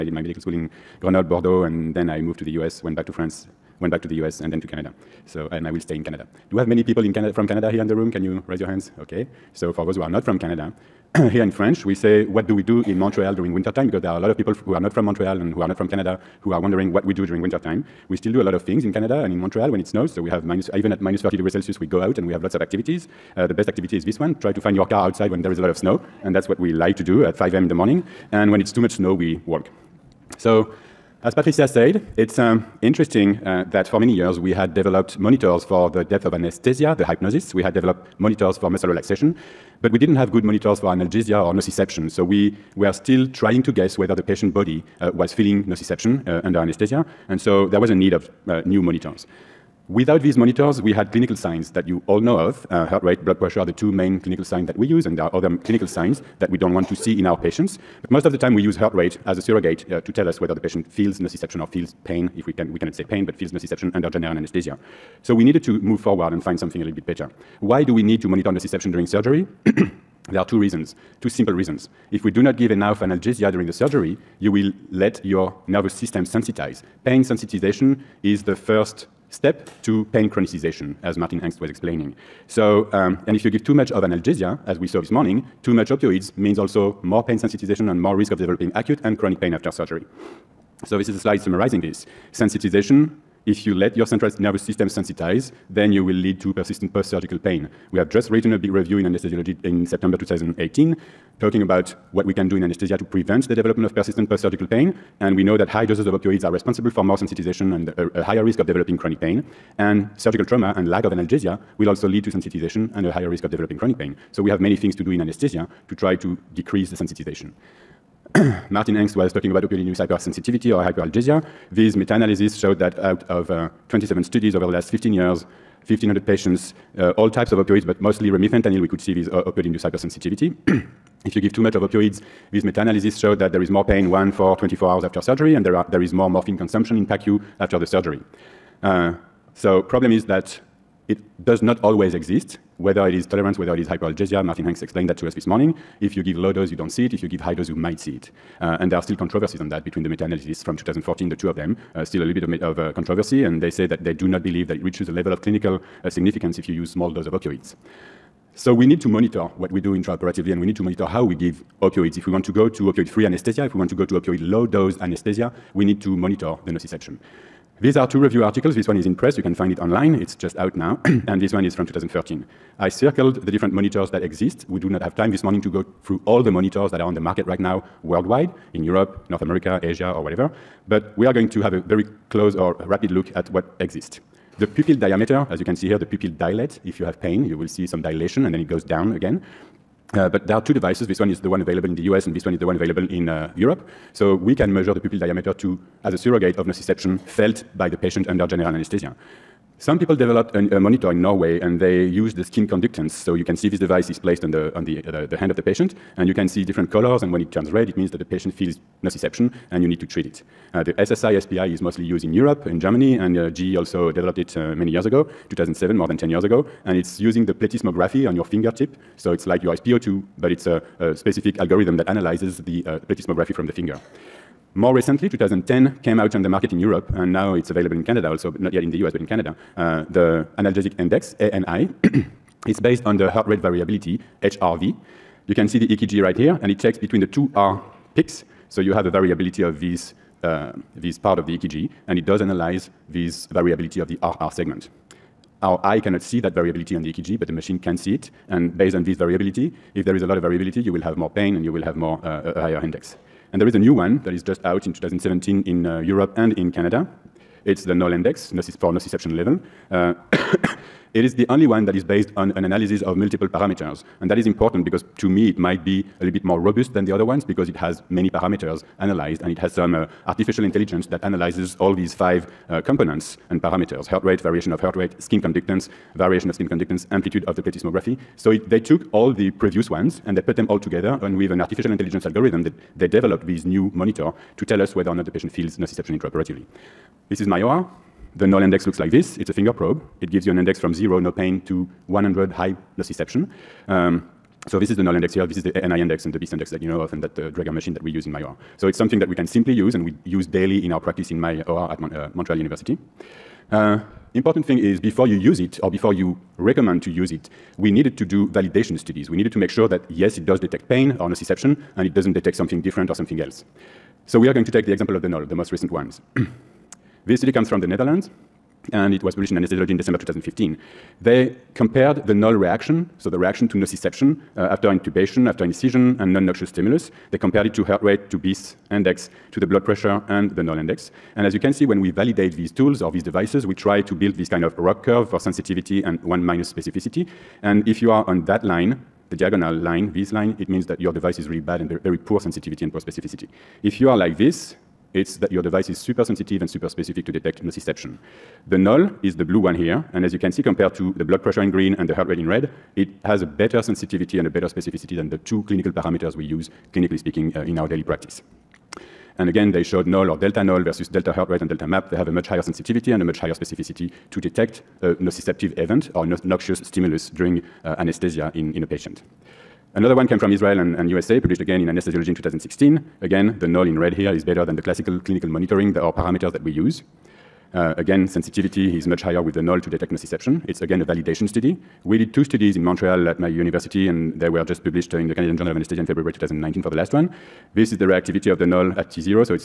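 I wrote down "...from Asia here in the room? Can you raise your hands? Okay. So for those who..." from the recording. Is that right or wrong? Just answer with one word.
wrong.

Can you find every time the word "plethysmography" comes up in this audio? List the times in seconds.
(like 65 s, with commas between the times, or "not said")
217 s, 223 s, 277 s.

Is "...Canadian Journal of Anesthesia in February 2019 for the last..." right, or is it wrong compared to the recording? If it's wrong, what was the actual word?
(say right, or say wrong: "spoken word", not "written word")
right.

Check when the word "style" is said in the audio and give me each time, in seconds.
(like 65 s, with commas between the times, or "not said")
not said.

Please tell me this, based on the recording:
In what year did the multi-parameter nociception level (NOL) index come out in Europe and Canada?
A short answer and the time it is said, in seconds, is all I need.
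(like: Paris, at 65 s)
2017, at 254 s.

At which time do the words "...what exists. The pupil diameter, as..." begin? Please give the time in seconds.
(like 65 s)
183 s.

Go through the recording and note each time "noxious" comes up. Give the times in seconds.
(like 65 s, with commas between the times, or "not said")
326 s, 366 s.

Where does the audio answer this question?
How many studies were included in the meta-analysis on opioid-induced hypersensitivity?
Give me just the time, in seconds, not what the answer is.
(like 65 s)
123 s.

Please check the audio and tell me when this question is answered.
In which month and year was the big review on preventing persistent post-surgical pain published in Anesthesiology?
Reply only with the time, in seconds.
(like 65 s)
99 s.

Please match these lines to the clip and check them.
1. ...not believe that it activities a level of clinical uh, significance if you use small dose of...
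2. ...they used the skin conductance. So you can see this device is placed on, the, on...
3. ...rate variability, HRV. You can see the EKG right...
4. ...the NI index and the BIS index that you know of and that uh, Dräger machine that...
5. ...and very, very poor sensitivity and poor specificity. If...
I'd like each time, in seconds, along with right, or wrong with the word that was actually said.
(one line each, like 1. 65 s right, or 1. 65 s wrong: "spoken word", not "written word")
1. 154 s wrong: "reaches", not "activities"
2. 201 s right
3. 233 s right
4. 295 s right
5. 341 s right.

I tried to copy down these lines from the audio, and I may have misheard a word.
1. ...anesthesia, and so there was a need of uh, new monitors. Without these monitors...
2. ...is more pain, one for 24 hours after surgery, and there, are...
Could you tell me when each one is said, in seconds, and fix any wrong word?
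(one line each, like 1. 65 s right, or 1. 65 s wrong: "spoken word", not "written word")
1. 46 s right
2. 133 s right.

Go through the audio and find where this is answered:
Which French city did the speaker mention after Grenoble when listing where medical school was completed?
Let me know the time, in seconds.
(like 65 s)
1 s.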